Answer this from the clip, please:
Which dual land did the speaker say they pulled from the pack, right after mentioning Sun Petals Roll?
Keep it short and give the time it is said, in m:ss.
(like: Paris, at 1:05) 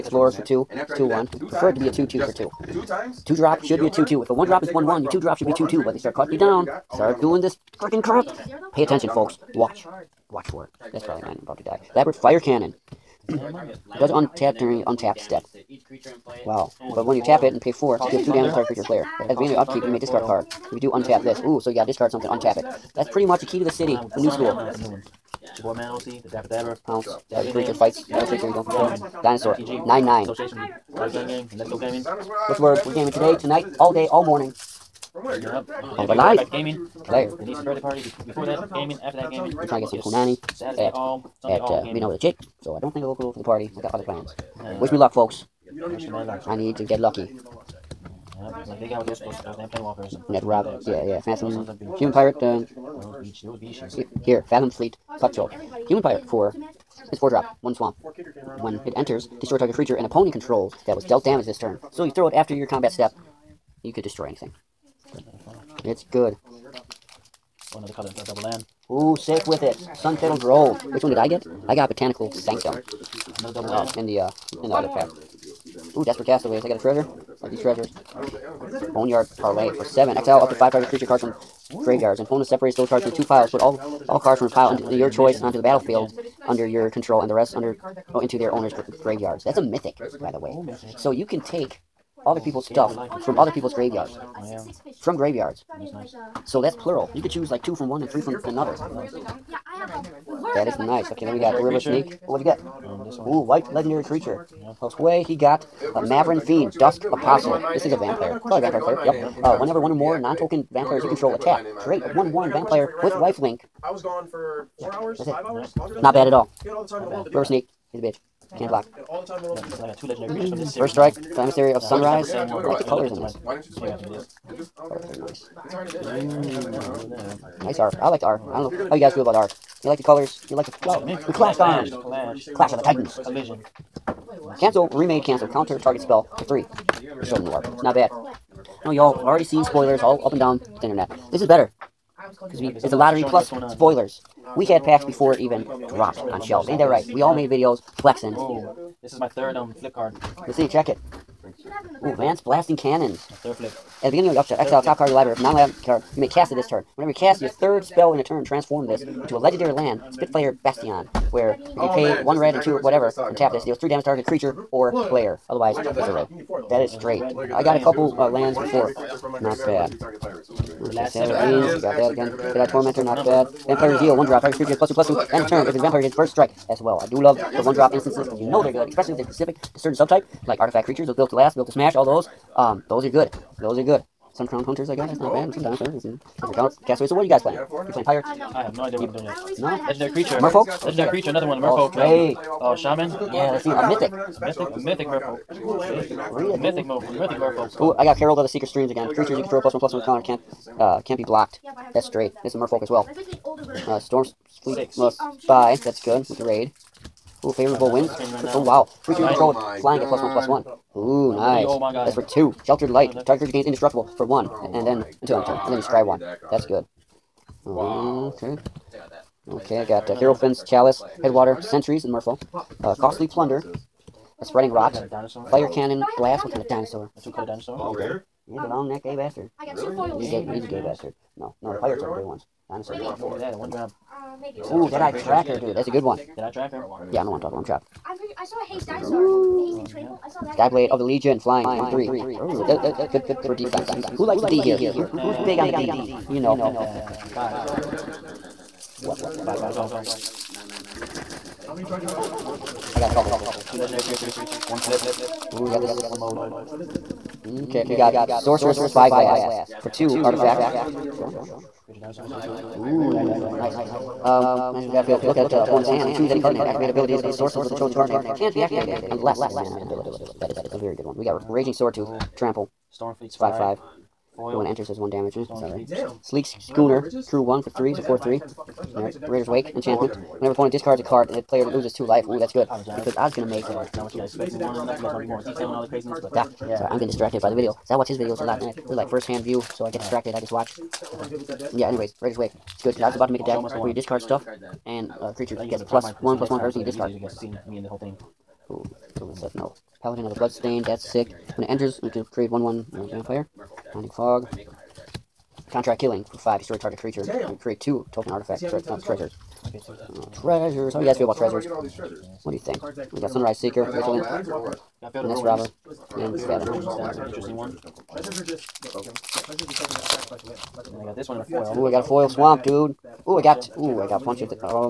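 Botanical Sanctum, at 1:11.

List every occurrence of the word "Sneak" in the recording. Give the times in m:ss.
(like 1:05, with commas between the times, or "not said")
1:57.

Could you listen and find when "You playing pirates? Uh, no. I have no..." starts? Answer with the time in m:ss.
3:07.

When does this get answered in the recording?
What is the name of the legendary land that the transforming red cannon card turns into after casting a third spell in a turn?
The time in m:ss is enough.
2:40.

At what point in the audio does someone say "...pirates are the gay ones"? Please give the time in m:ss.
3:51.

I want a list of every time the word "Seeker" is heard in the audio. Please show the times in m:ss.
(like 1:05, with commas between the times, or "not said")
3:18, 5:13.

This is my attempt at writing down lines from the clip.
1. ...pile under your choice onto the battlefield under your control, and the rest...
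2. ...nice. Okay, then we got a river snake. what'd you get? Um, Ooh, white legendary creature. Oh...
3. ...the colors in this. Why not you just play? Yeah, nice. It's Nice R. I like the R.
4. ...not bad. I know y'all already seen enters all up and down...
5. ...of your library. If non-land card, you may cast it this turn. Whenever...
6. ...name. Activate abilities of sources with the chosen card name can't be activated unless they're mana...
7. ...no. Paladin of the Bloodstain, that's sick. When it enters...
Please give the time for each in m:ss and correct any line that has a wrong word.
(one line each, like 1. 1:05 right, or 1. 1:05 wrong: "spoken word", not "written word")
1. 1:24 right
2. 1:40 right
3. 2:02 right
4. 2:17 wrong: "spoilers", not "enters"
5. 2:35 right
6. 4:26 right
7. 4:59 right.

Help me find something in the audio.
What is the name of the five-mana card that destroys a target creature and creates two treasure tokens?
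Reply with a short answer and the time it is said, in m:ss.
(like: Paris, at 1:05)
Contract Killing, at 5:05.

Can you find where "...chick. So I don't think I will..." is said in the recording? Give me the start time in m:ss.
0:42.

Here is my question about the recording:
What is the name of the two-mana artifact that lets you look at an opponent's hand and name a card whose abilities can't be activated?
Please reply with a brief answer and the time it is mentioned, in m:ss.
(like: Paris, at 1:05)
Sorcerous Spyglass, at 4:18.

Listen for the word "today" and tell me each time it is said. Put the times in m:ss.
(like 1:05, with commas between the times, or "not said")
0:33.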